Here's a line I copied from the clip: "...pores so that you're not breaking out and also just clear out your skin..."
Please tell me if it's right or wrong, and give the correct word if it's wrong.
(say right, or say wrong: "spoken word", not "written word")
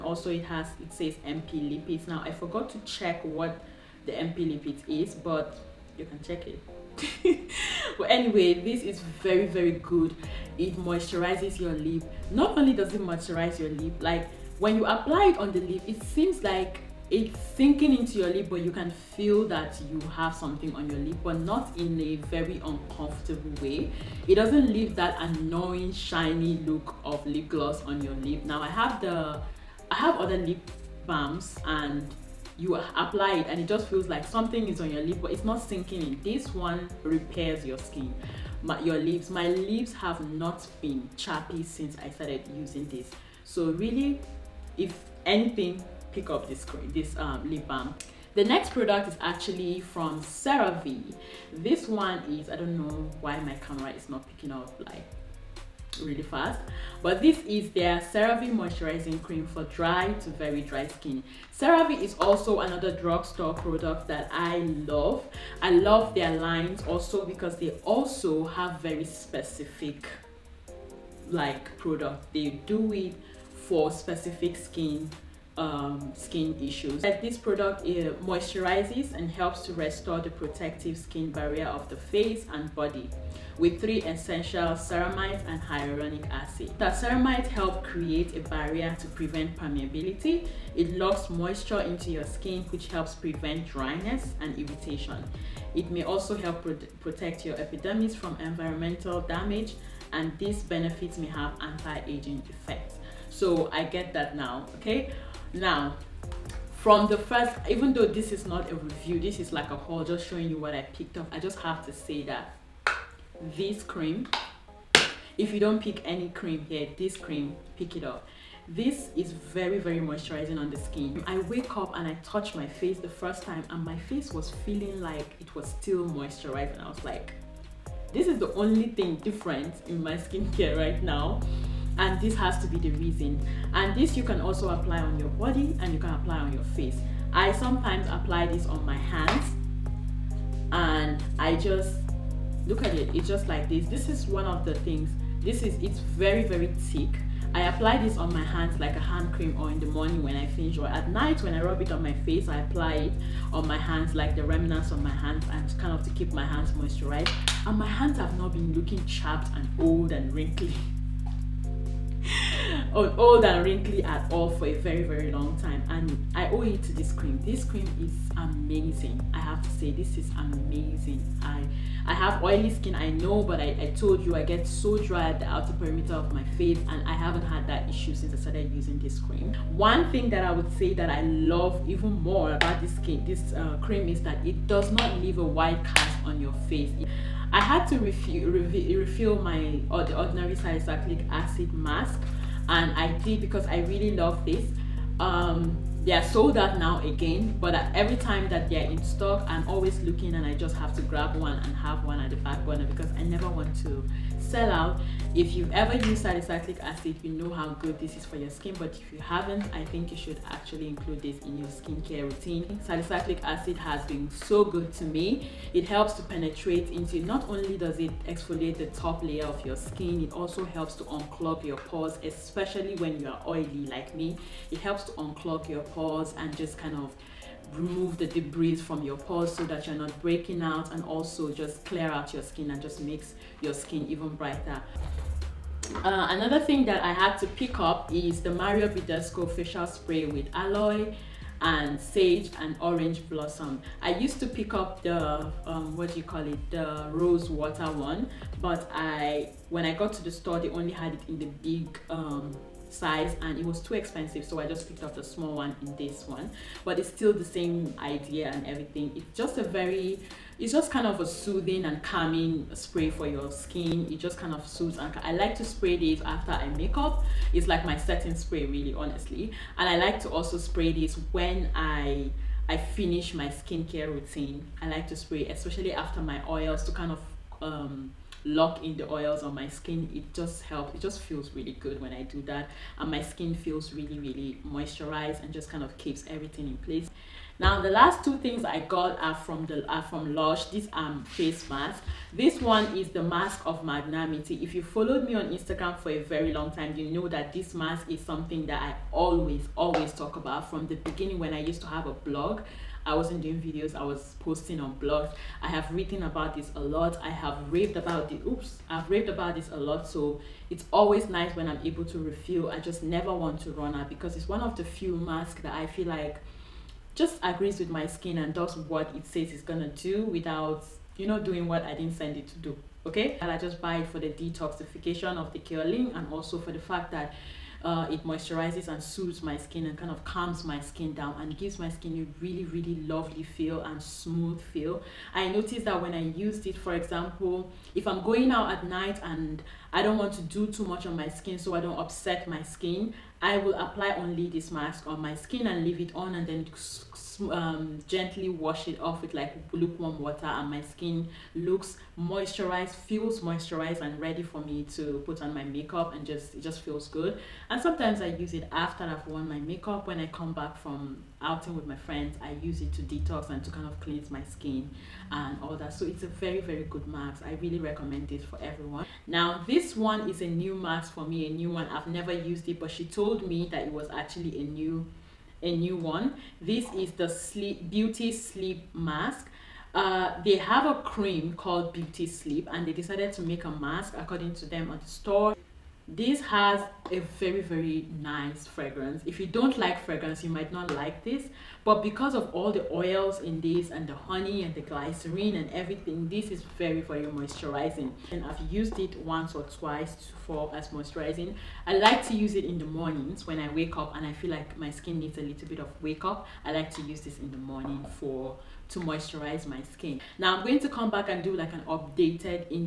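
right.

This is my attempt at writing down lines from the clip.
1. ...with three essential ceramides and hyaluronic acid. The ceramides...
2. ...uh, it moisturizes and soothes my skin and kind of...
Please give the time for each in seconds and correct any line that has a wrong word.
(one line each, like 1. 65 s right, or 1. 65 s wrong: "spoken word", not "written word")
1. 83 s right
2. 327 s right.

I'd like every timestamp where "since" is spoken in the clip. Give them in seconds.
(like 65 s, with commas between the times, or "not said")
41 s, 178 s.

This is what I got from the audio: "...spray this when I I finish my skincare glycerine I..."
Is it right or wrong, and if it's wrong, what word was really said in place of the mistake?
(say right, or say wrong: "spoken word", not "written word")
wrong: "routine", not "glycerine".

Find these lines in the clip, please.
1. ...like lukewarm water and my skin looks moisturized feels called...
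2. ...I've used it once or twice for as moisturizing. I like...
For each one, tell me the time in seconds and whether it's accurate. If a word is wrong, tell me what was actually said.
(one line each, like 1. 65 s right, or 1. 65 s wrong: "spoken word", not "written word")
1. 349 s wrong: "moisturized", not "called"
2. 398 s right.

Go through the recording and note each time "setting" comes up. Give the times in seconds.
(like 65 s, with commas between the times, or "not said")
267 s.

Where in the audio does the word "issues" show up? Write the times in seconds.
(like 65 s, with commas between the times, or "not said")
76 s, 177 s.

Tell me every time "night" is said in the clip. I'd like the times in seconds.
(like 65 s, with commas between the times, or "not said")
151 s, 338 s.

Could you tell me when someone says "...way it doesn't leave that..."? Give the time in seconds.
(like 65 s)
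23 s.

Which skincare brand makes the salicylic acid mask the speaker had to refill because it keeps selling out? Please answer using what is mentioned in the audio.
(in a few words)
The Ordinary.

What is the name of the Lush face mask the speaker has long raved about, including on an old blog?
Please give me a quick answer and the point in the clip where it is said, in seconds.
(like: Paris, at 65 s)
Mask of Magnanimity, at 293 s.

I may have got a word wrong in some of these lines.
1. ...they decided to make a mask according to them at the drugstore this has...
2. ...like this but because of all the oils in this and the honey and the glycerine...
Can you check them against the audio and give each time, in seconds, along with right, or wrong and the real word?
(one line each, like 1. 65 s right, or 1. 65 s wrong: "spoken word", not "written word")
1. 382 s wrong: "store", not "drugstore"
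2. 390 s right.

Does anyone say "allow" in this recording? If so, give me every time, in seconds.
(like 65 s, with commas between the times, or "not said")
not said.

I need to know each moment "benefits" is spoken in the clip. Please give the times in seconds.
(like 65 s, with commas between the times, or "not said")
100 s.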